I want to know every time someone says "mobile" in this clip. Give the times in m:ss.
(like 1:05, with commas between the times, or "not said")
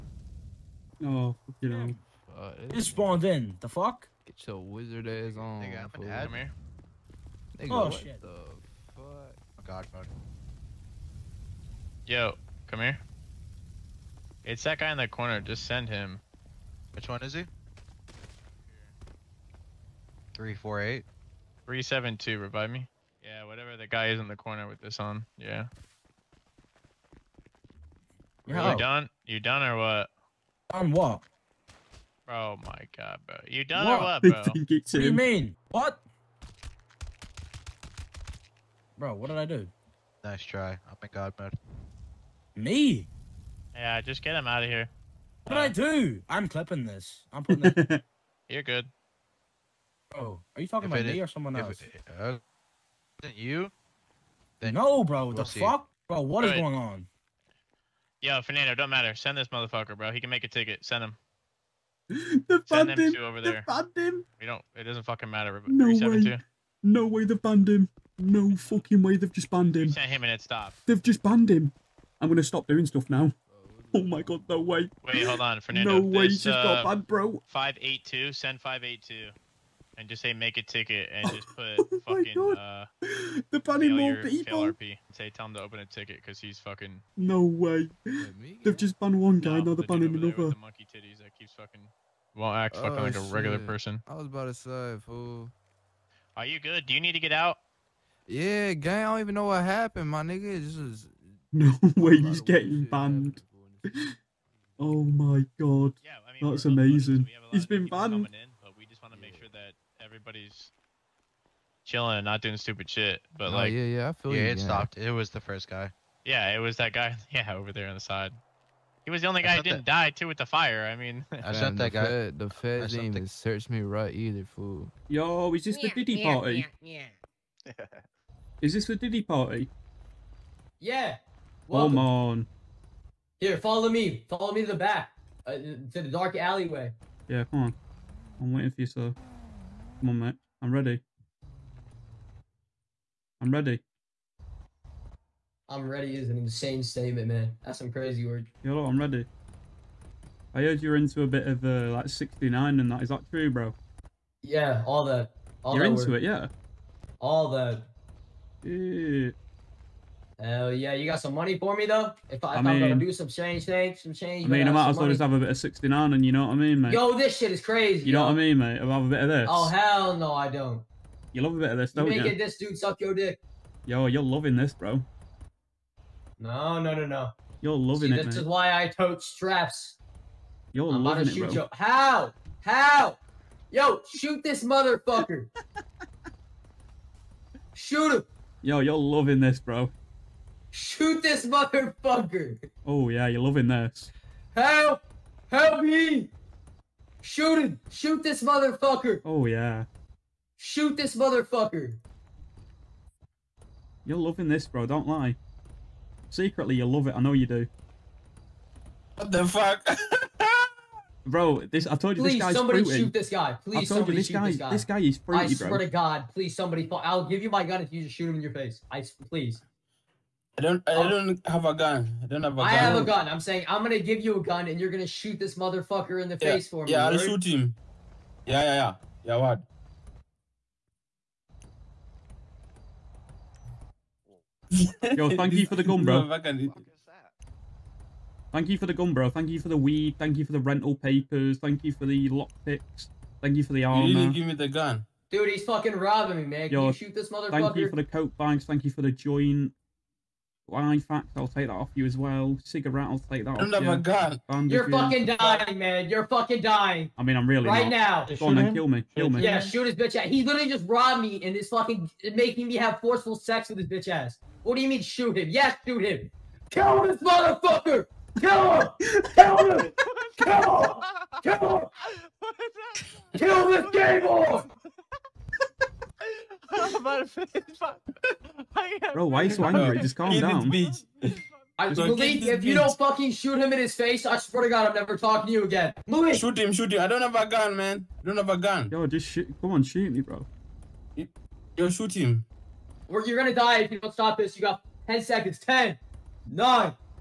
not said.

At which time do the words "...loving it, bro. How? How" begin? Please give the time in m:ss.
3:01.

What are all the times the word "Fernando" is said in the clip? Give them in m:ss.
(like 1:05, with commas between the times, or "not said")
0:58, 1:15.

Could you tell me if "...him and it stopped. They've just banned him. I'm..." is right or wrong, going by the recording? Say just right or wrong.
right.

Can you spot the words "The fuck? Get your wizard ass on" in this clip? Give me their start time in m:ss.
0:03.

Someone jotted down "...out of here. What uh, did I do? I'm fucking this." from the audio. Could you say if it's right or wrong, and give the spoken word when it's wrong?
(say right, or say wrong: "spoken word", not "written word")
wrong: "clipping", not "fucking".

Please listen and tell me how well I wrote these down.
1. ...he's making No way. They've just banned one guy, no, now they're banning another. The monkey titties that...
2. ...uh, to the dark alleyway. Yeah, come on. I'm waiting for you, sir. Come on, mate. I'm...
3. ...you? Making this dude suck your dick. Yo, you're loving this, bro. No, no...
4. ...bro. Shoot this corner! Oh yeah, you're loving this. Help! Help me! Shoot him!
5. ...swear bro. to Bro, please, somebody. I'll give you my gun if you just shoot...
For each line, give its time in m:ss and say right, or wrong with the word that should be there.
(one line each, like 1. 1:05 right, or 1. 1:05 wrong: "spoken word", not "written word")
1. 1:26 wrong: "fucking", not "making"
2. 2:15 right
3. 2:52 right
4. 3:09 wrong: "motherfucker", not "corner"
5. 3:35 wrong: "God", not "Bro".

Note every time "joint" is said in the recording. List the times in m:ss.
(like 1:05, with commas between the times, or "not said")
4:09.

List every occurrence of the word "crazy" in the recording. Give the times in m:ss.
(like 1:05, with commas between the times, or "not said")
2:27, 2:47.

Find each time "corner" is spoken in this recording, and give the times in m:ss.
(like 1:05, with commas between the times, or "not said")
0:15, 0:24.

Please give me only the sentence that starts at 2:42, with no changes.
If, I, if I am gonna do some change things, some change.